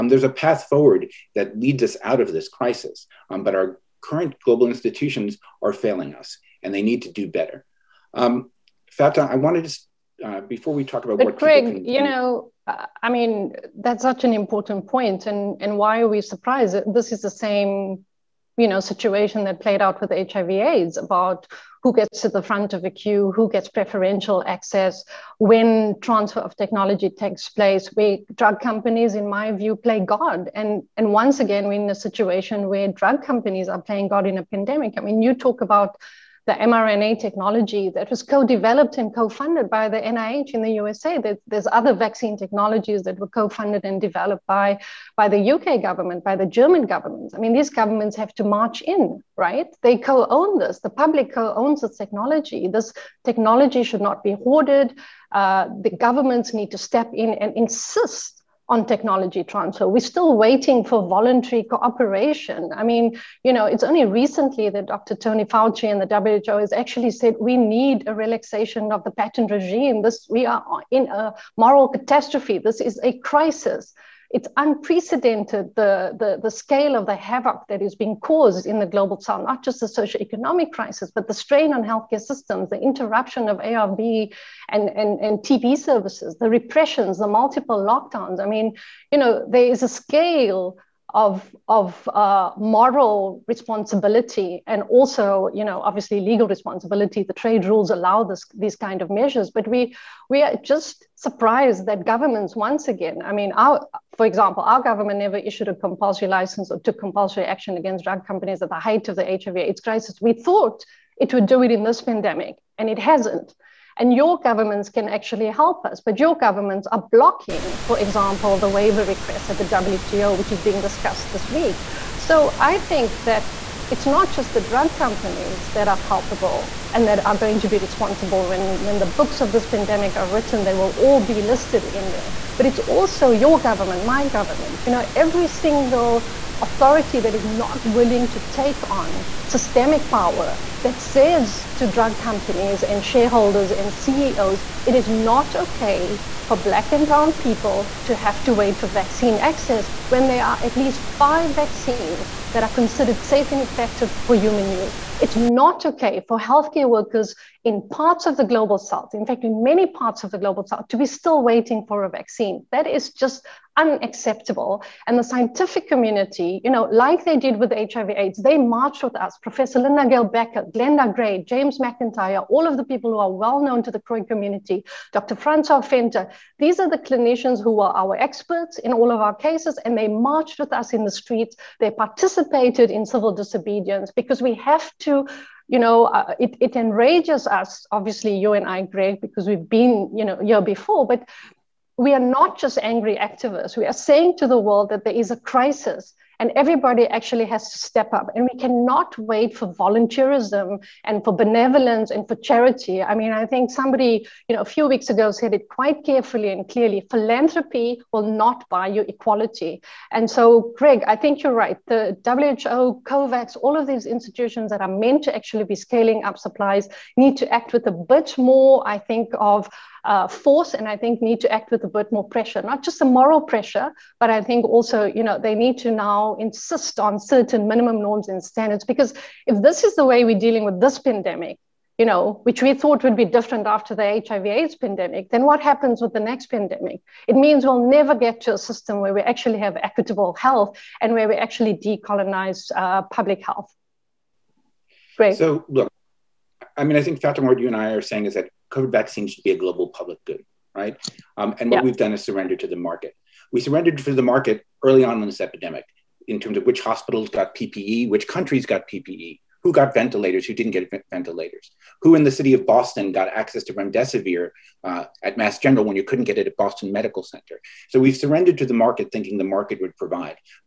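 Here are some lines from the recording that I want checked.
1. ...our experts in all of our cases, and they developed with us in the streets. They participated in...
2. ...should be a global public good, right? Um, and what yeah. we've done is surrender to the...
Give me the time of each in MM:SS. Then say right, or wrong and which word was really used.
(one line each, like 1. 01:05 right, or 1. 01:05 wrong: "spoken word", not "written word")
1. 02:57 wrong: "marched", not "developed"
2. 04:09 right.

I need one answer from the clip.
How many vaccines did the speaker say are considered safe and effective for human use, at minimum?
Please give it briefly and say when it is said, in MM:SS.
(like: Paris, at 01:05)
5, at 02:31.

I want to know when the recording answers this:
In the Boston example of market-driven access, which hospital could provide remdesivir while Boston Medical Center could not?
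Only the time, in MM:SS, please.
04:25.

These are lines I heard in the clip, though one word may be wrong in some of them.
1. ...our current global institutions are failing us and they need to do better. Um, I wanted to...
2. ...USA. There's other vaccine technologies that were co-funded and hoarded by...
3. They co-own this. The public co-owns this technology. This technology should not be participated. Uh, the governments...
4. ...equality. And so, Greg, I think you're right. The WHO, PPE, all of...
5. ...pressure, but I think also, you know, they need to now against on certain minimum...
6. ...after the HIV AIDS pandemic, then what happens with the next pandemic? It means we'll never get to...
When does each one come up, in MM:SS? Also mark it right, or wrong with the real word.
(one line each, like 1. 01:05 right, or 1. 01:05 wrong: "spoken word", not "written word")
1. 00:03 right
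2. 00:40 wrong: "developed", not "hoarded"
3. 00:49 wrong: "hoarded", not "participated"
4. 03:29 wrong: "COVAX", not "PPE"
5. 03:43 wrong: "insist", not "against"
6. 03:53 right.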